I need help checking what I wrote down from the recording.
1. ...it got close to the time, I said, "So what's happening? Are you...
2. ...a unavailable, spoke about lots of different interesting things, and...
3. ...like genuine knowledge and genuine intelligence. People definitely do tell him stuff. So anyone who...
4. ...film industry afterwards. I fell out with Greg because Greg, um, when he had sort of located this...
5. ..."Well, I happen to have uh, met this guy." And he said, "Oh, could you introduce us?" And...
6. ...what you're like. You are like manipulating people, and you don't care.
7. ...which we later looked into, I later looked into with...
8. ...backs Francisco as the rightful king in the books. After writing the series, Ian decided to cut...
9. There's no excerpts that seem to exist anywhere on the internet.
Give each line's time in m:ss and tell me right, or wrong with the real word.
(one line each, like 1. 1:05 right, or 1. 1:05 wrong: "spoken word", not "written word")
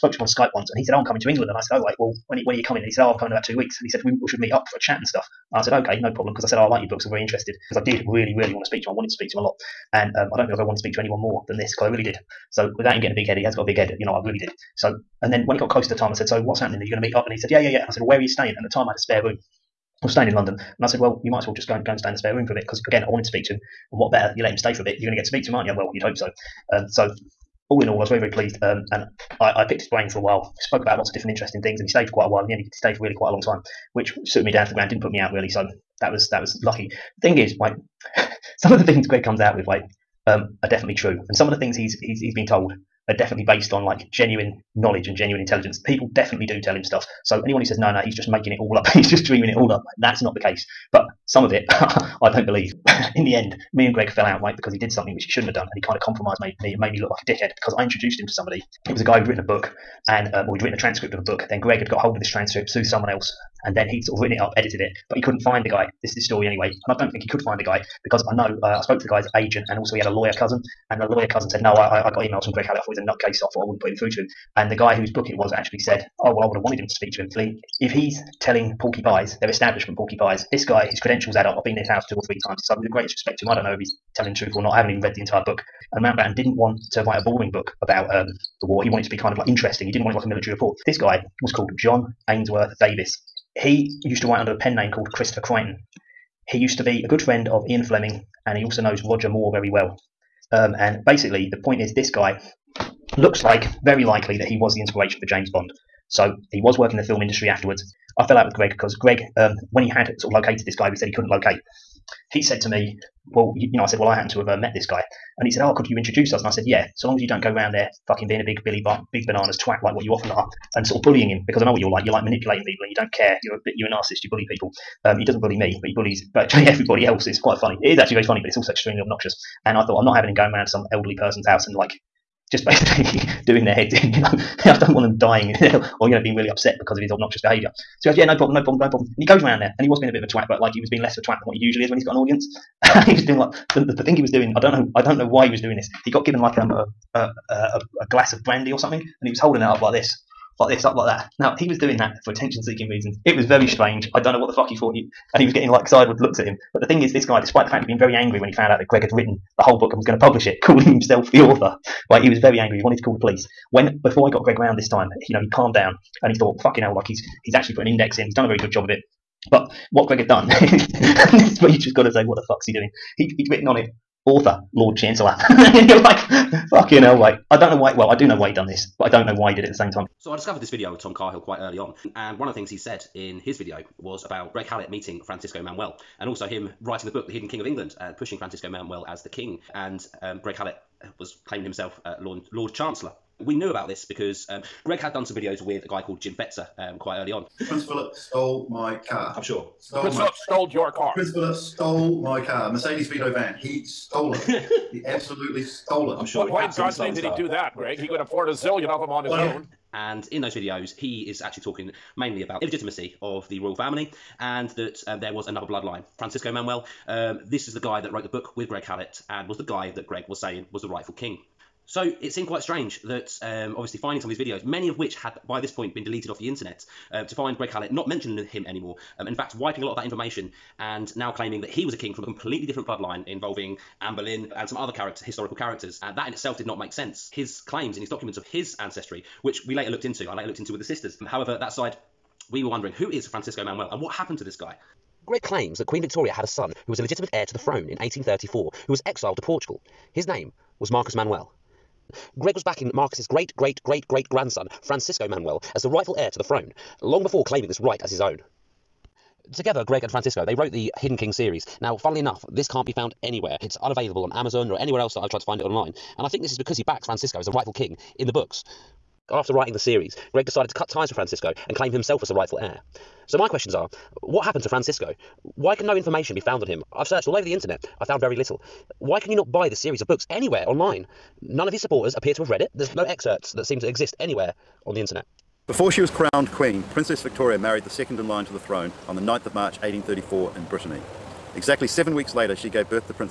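1. 0:15 right
2. 0:30 wrong: "while", not "unavailable"
3. 0:43 right
4. 1:47 right
5. 1:53 right
6. 2:01 right
7. 3:59 right
8. 4:26 wrong: "Greg", not "Ian"
9. 4:42 right.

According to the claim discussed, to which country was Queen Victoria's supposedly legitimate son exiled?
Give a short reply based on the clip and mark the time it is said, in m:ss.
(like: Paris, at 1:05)
Portugal, at 4:09.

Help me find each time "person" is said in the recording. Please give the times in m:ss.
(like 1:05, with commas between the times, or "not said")
2:11.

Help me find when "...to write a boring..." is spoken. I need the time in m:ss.
1:26.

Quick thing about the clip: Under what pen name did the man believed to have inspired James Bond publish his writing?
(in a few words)
Christopher Creighton.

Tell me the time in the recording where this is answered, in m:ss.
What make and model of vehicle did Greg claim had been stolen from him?
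3:22.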